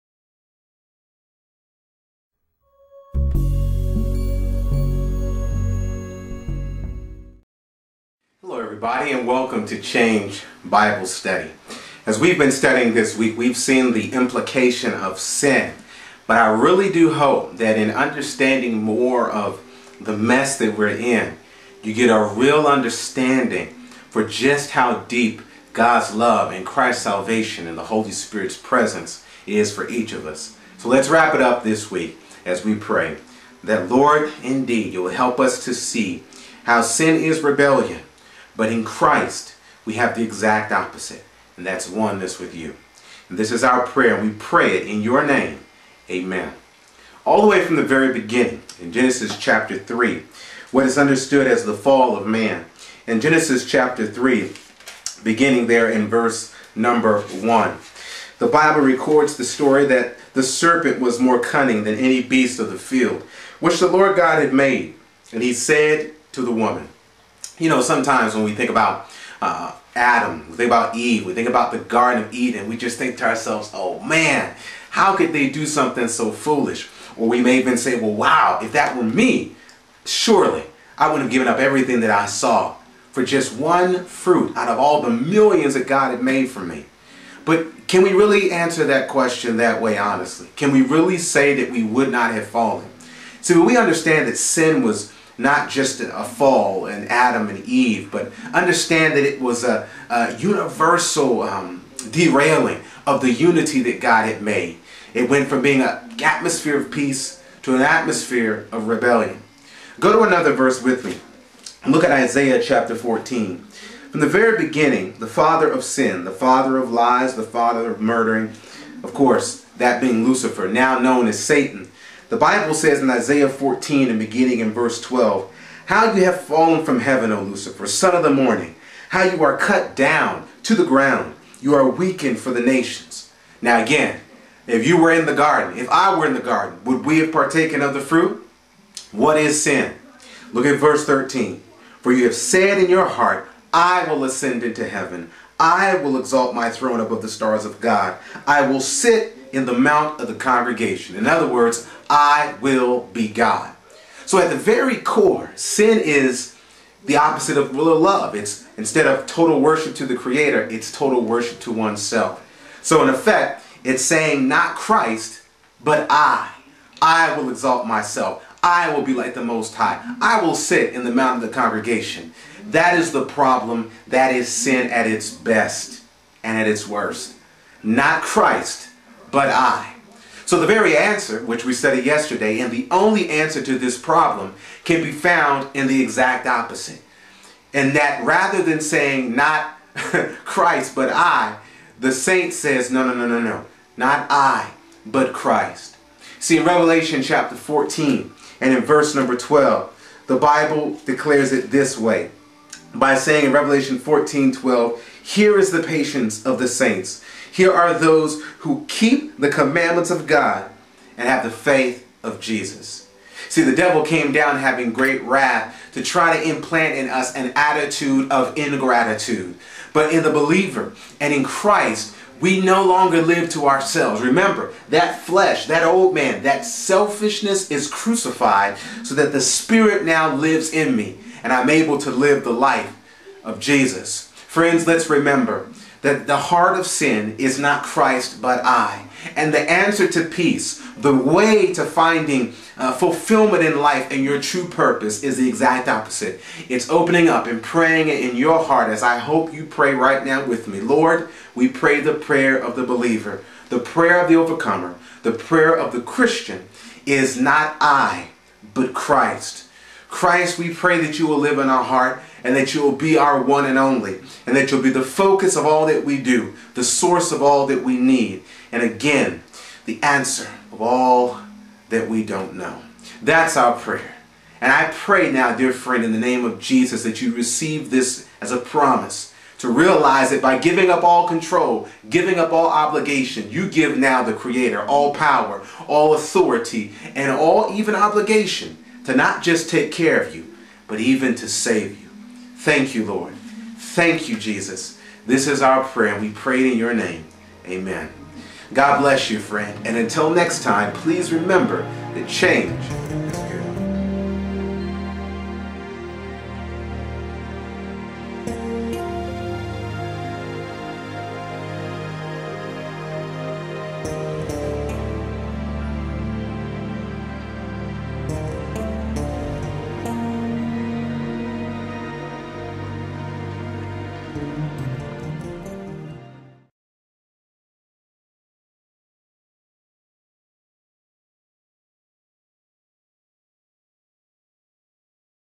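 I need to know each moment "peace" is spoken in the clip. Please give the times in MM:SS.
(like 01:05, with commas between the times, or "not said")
01:46, 04:00.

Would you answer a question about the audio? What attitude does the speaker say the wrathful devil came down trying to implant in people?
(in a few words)
ingratitude.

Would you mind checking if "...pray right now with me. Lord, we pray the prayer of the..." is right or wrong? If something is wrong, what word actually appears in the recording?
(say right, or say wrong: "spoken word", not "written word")
right.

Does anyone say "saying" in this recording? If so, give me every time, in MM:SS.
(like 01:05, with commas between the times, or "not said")
02:44, 03:08, 03:23.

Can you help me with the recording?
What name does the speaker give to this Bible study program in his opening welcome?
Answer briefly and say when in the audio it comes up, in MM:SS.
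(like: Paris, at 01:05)
Change Bible Study, at 00:09.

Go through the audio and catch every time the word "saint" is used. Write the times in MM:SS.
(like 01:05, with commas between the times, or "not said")
03:12, 03:26.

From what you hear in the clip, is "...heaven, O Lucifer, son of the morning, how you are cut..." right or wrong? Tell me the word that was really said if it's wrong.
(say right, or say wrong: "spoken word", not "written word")
right.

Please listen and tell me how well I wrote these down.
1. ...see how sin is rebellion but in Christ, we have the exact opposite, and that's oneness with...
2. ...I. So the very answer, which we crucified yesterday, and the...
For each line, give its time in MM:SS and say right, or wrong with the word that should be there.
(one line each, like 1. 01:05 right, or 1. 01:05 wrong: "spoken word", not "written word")
1. 00:35 right
2. 02:59 wrong: "studied", not "crucified".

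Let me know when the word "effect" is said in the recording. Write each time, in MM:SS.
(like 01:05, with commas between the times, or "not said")
02:43.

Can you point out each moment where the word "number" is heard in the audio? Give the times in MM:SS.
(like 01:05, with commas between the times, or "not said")
00:56, 03:19.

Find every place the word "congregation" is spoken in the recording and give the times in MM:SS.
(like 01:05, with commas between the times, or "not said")
02:30, 02:51.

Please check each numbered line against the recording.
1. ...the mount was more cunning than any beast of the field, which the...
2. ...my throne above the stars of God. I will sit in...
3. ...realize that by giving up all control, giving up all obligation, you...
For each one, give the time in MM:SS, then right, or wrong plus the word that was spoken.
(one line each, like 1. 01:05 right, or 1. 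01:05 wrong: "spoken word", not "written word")
1. 01:00 wrong: "serpent", not "mount"
2. 02:26 right
3. 04:39 right.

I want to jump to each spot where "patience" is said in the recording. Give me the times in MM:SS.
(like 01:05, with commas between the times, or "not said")
03:25.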